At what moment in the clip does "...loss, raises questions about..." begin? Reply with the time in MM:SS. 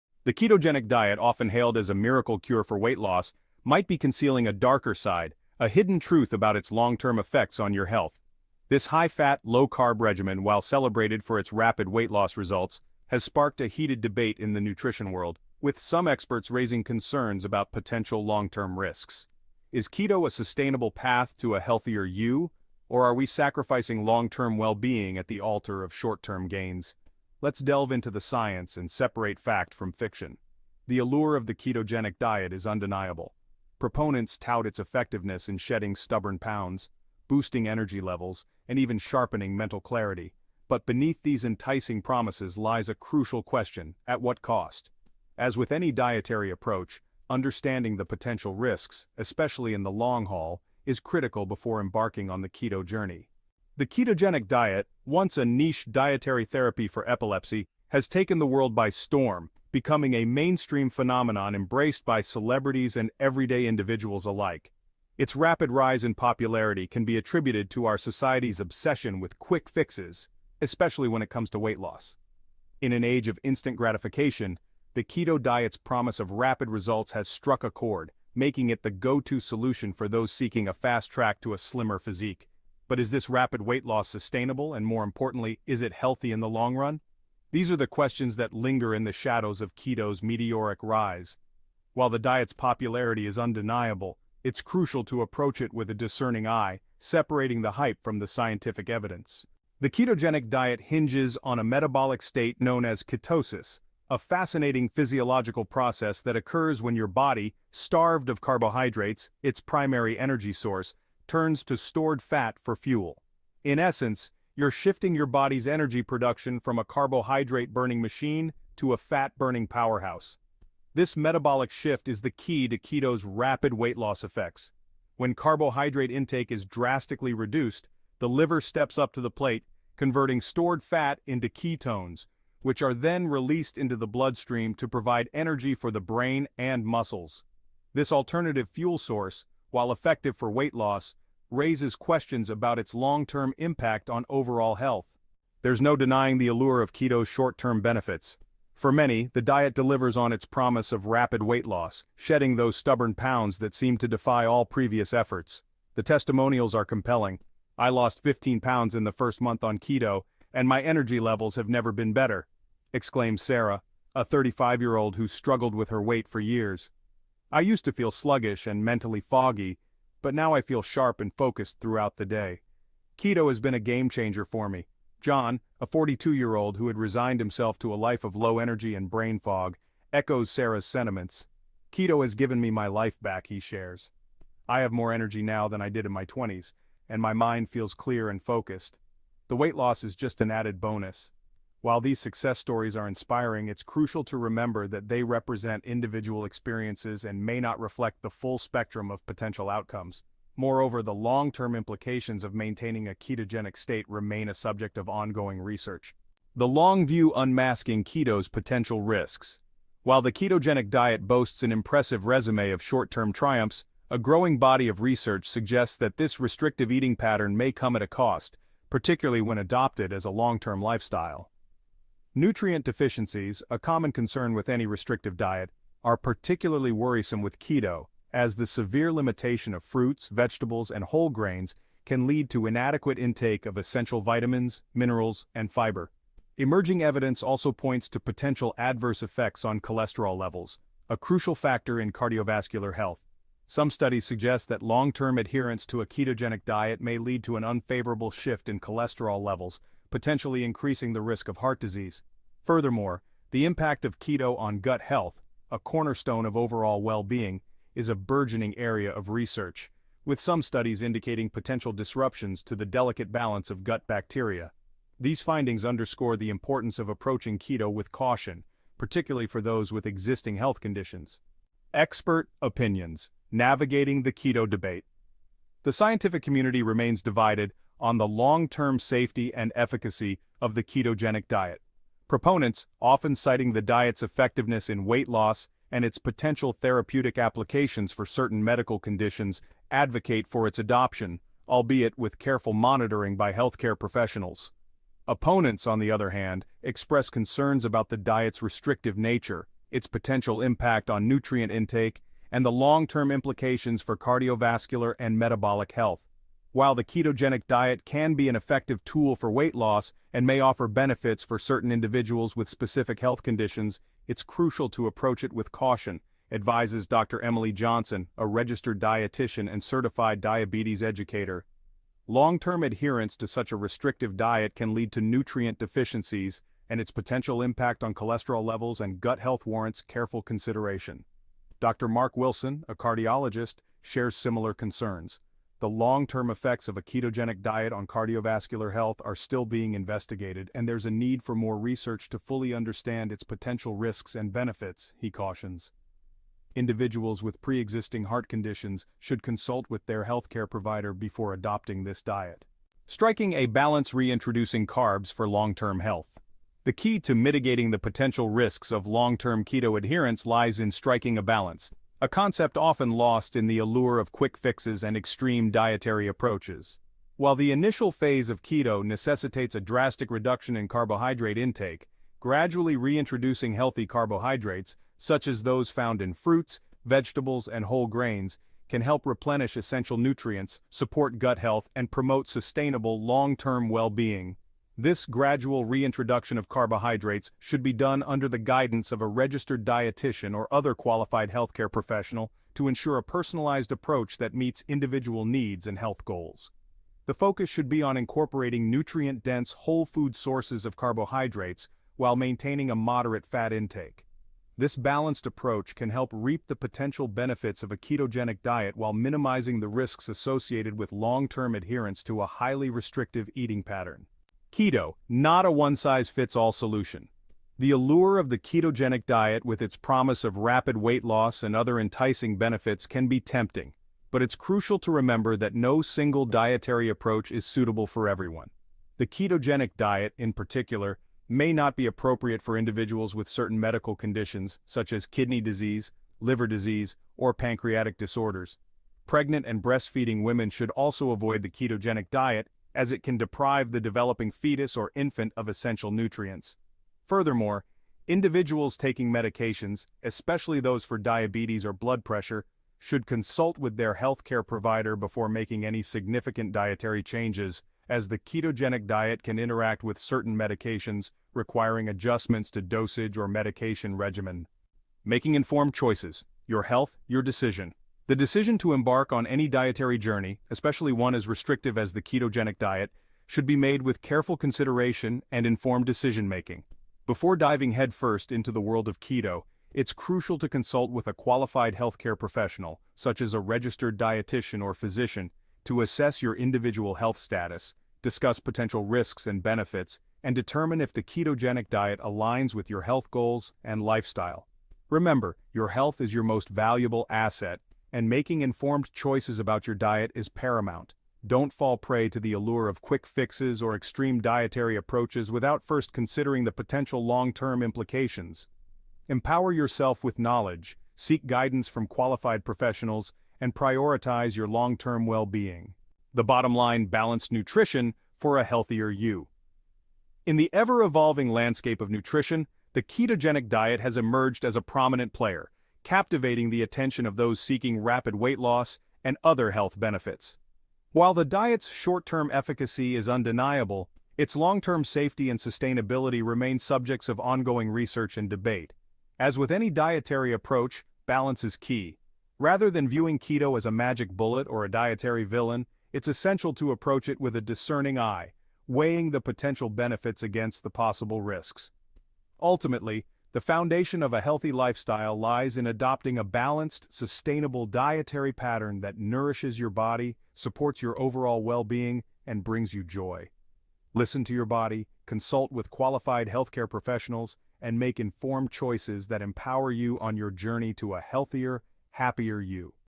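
02:20.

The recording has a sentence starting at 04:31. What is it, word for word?
Expert Opinions Navigating the Keto Debate The scientific community remains divided on the long-term safety and efficacy of the ketogenic diet.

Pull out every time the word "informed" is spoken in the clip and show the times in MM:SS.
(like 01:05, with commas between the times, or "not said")
07:45, 07:55, 08:18, 09:28.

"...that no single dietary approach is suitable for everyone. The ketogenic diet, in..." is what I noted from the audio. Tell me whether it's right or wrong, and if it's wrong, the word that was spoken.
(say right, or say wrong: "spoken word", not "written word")
right.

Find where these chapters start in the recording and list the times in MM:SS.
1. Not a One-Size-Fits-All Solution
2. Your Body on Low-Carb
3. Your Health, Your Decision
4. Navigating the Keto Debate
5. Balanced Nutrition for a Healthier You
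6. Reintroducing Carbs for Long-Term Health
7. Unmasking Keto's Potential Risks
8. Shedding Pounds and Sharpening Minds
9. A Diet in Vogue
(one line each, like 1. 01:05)
1. 06:54
2. 01:39
3. 07:44
4. 04:31
5. 08:36
6. 05:52
7. 03:26
8. 02:25
9. 00:53.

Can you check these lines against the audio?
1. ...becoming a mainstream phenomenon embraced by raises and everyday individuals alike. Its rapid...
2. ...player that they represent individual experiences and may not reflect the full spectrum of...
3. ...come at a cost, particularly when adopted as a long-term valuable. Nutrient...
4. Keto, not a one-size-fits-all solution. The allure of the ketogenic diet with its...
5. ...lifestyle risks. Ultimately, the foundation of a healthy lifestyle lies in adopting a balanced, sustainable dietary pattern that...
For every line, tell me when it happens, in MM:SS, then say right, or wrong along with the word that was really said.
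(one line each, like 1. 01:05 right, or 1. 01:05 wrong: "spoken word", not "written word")
1. 00:59 wrong: "celebrities", not "raises"
2. 03:14 wrong: "remember", not "player"
3. 03:37 wrong: "lifestyle", not "valuable"
4. 06:54 right
5. 09:10 wrong: "possible", not "lifestyle".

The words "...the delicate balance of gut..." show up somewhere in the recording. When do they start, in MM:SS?
04:22.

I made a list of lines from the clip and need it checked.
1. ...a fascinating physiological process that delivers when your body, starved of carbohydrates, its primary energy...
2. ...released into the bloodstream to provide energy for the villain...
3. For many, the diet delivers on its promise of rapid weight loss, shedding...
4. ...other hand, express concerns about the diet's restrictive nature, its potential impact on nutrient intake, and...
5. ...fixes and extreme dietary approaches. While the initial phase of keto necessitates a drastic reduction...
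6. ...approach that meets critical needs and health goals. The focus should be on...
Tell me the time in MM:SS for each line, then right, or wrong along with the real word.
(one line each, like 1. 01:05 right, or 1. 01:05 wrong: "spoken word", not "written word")
1. 01:44 wrong: "occurs", not "delivers"
2. 02:13 wrong: "brain", not "villain"
3. 02:28 right
4. 04:56 right
5. 06:04 right
6. 06:33 wrong: "individual", not "critical".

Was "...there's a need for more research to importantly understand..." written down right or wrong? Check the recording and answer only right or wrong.
wrong.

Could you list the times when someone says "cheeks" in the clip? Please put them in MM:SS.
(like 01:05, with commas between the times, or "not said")
not said.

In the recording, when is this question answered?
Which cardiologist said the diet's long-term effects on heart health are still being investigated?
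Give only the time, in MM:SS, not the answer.
05:31.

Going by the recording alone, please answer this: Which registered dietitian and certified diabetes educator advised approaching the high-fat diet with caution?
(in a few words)
Dr. Emily Johnson.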